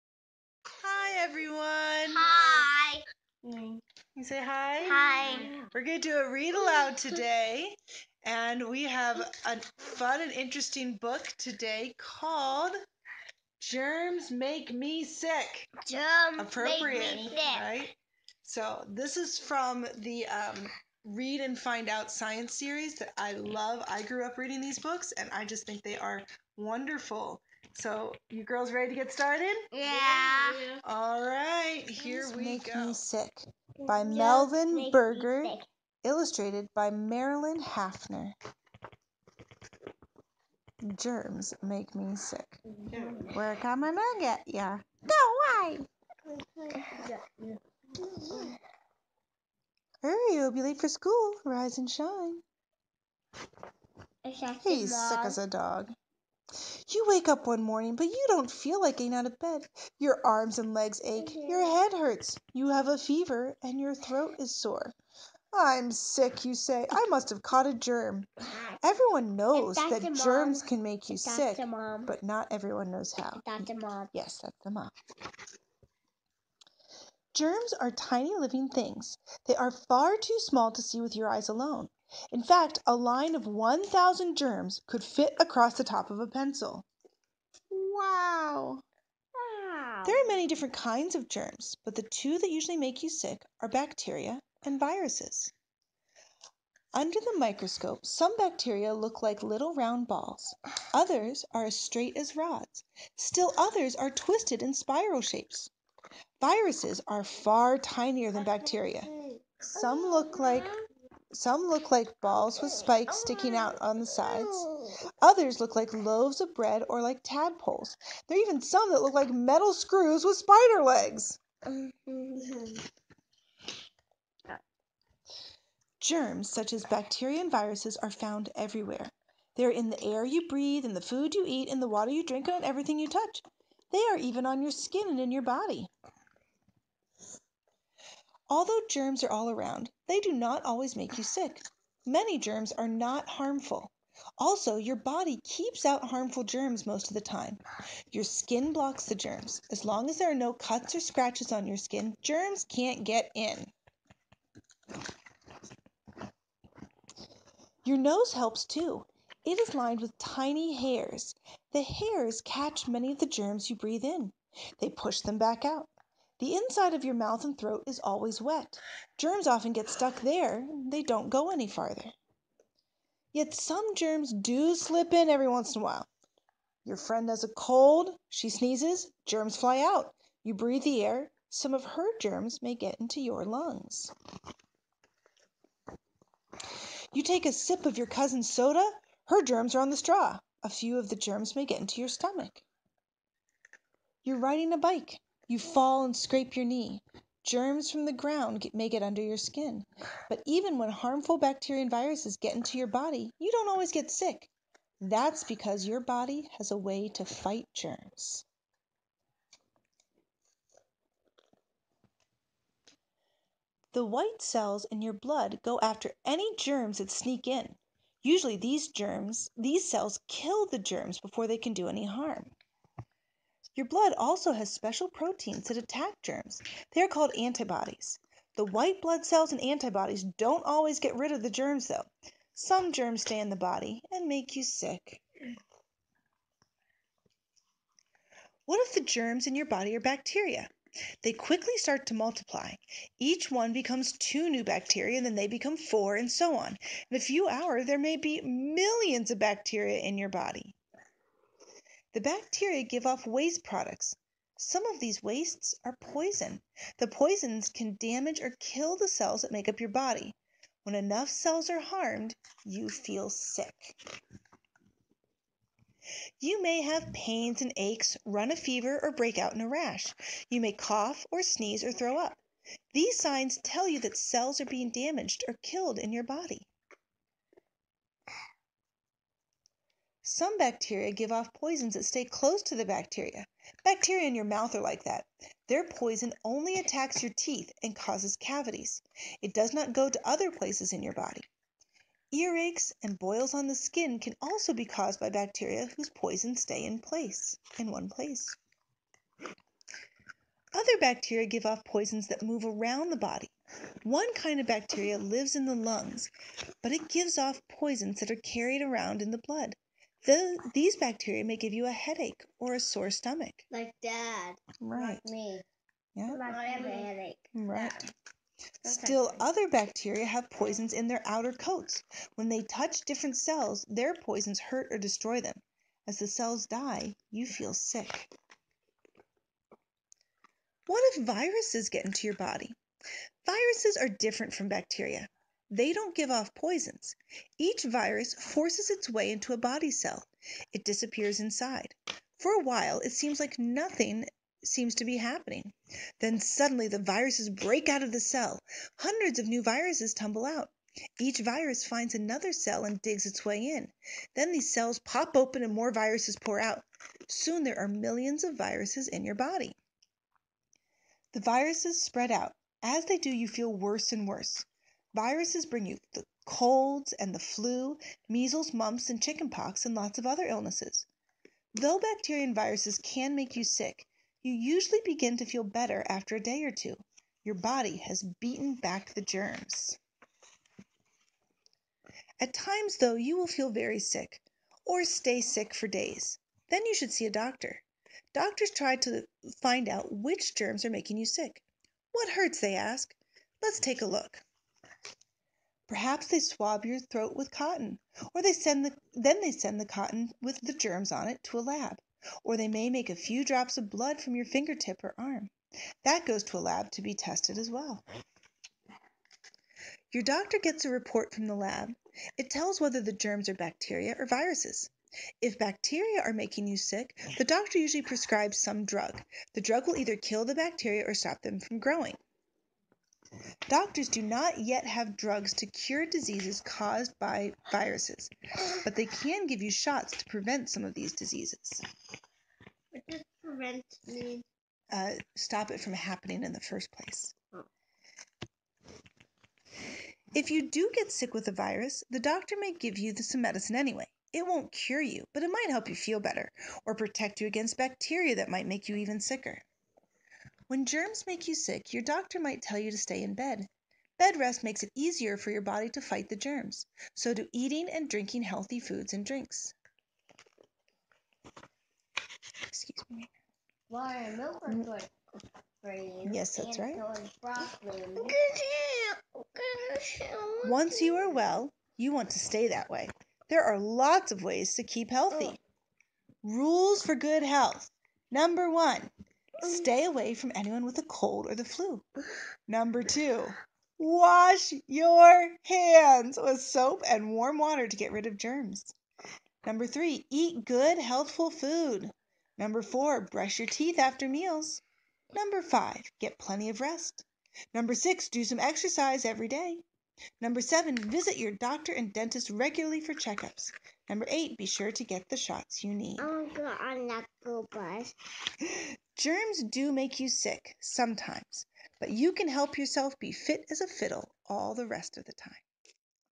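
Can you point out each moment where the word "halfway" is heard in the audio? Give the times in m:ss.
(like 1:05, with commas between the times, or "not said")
not said.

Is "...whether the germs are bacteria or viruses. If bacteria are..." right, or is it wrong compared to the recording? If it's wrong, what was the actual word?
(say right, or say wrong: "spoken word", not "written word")
right.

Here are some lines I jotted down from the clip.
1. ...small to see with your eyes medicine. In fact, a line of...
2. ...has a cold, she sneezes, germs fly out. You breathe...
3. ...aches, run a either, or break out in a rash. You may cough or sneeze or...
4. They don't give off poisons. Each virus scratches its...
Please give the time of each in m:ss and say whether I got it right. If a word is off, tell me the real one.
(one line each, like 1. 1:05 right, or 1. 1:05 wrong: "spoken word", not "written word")
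1. 1:20 wrong: "alone", not "medicine"
2. 2:57 right
3. 4:27 wrong: "fever", not "either"
4. 5:35 wrong: "forces", not "scratches".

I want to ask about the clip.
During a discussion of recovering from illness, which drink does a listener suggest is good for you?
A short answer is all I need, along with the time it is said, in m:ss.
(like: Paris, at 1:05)
milk, at 7:44.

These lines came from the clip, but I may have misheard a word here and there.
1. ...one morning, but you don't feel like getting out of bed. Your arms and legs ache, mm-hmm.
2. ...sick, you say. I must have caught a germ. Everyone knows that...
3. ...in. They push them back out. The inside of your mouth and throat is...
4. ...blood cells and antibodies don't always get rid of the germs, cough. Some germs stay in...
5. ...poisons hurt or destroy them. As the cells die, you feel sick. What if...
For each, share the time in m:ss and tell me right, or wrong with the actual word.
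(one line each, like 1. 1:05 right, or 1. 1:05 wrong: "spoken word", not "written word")
1. 0:57 right
2. 1:05 right
3. 2:44 right
4. 3:49 wrong: "though", not "cough"
5. 5:24 right.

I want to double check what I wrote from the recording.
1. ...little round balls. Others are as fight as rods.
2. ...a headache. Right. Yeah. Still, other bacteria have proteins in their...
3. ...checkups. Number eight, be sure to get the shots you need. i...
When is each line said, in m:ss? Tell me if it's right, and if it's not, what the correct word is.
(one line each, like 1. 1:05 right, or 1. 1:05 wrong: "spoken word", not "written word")
1. 1:39 wrong: "straight", not "fight"
2. 5:16 wrong: "poisons", not "proteins"
3. 8:23 right.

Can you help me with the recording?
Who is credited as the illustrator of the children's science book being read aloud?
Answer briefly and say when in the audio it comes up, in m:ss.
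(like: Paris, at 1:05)
Marilyn Hafner, at 0:36.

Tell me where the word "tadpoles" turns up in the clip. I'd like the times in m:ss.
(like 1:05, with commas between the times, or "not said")
1:57.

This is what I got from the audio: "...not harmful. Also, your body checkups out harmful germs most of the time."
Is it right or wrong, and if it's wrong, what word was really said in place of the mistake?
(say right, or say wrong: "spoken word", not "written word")
wrong: "keeps", not "checkups".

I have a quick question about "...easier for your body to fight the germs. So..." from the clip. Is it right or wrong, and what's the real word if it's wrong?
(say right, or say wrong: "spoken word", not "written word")
right.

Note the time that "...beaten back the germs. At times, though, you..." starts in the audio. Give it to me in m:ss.
6:18.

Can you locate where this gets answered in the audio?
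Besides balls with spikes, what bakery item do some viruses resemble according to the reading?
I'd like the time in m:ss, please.
1:55.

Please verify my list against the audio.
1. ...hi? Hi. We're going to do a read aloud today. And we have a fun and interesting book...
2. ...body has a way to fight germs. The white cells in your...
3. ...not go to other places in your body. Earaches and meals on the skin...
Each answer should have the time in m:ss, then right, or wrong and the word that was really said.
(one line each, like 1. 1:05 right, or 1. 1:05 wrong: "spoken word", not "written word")
1. 0:04 right
2. 3:25 right
3. 4:49 wrong: "boils", not "meals".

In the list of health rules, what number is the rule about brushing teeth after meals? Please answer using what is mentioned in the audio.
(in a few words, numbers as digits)
4.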